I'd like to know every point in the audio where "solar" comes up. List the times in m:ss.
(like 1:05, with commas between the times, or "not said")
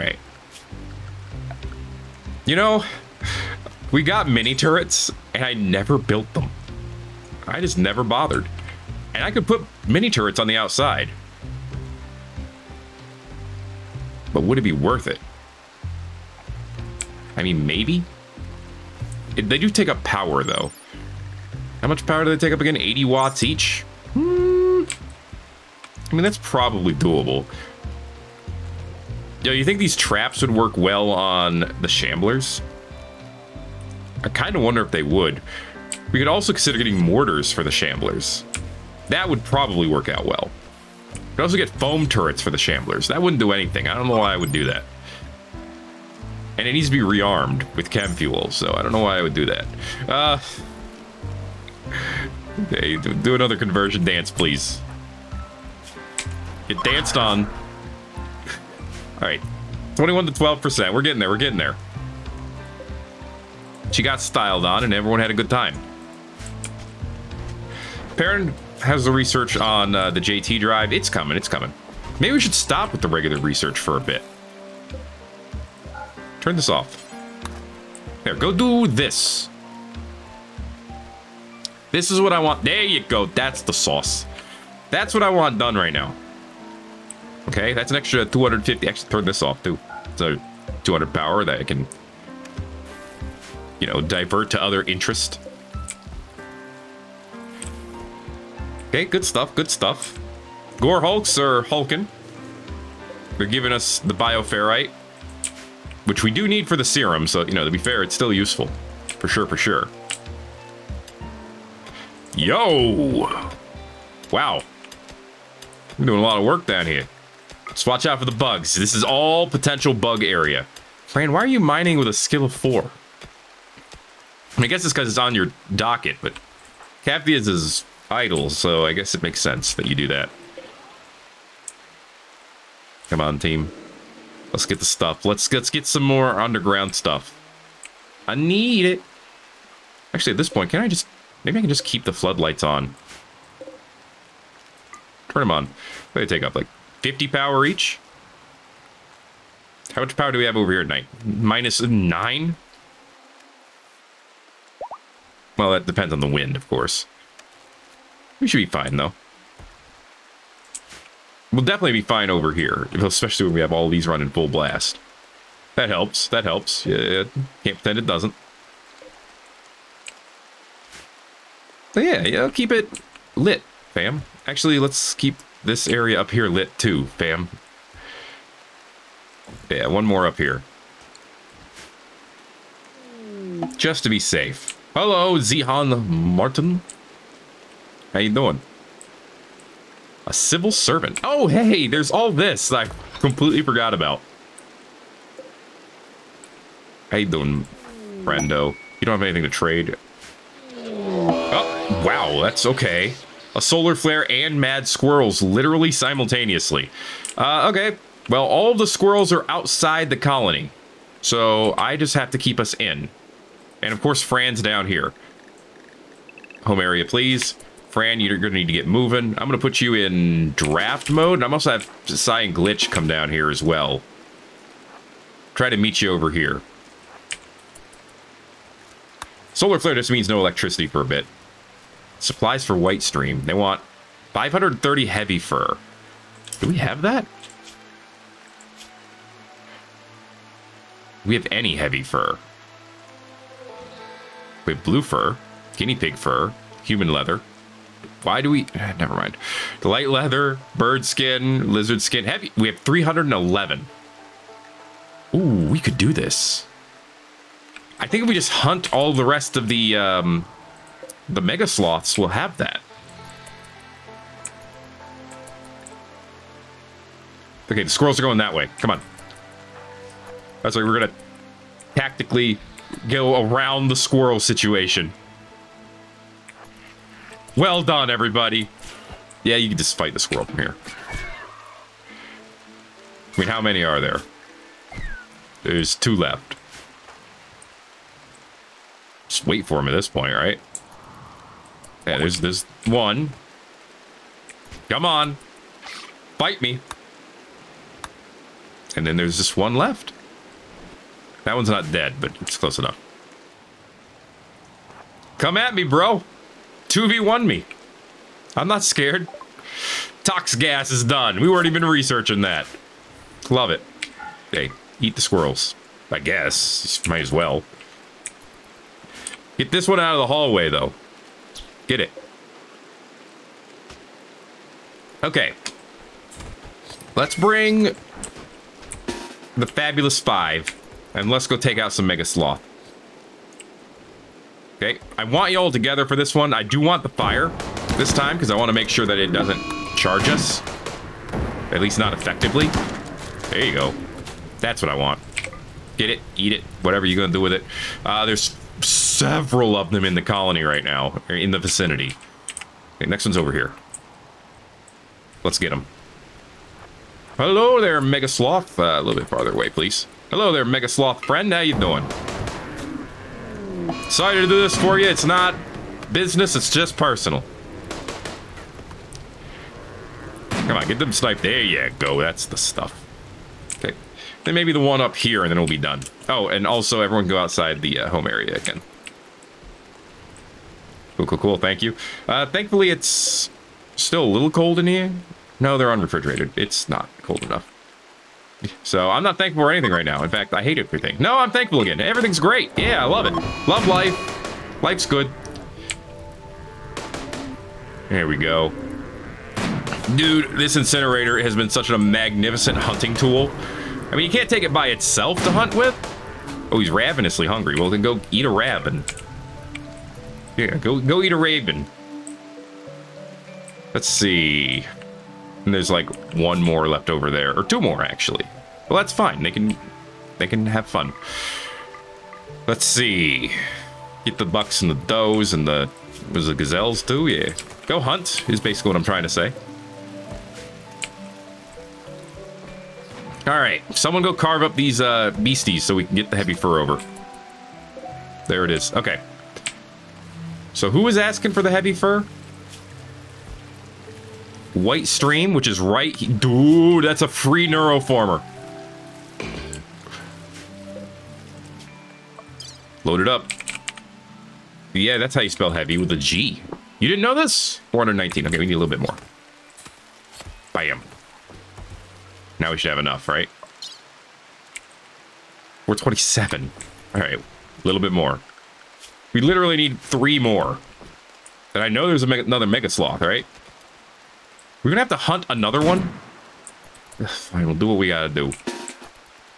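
3:23, 3:49.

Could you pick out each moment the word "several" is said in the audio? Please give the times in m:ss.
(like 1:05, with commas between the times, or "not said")
5:49.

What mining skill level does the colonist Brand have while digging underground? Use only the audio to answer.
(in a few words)
4.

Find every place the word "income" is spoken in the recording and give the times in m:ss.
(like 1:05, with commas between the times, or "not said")
not said.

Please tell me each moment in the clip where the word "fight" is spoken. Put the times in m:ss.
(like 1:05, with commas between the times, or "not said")
4:39.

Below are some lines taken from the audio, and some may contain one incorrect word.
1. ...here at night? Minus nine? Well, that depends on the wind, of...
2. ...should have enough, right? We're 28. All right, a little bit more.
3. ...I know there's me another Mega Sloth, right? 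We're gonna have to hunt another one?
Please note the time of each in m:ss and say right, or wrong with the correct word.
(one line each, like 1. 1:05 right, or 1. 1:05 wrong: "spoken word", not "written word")
1. 2:30 right
2. 7:42 wrong: "27", not "28"
3. 7:51 right.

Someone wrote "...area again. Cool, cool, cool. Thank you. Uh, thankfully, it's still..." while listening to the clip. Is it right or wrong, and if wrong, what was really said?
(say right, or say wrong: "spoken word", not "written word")
right.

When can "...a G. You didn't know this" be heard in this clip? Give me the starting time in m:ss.
7:36.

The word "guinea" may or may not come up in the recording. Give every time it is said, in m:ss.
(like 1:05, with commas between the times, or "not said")
4:05.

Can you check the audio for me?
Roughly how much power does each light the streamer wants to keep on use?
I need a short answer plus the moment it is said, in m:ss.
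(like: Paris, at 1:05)
50, at 2:27.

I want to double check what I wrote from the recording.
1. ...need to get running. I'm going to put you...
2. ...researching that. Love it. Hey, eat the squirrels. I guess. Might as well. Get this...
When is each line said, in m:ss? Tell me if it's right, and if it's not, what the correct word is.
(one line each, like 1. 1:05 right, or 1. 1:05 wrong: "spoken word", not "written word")
1. 3:38 wrong: "moving", not "running"
2. 5:11 right.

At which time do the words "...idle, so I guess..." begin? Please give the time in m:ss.
2:08.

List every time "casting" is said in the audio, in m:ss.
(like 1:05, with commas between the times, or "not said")
not said.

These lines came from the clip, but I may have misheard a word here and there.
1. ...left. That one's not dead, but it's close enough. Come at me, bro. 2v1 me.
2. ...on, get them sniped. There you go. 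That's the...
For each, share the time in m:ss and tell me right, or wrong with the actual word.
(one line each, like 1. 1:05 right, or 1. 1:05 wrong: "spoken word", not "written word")
1. 4:59 right
2. 6:10 right.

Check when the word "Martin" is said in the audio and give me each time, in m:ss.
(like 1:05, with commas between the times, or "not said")
3:06.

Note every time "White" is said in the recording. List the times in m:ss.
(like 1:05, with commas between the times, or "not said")
3:52, 7:24.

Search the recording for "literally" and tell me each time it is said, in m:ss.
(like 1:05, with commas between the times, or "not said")
3:25, 7:49.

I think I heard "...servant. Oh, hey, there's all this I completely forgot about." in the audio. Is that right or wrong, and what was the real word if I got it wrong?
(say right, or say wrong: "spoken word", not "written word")
right.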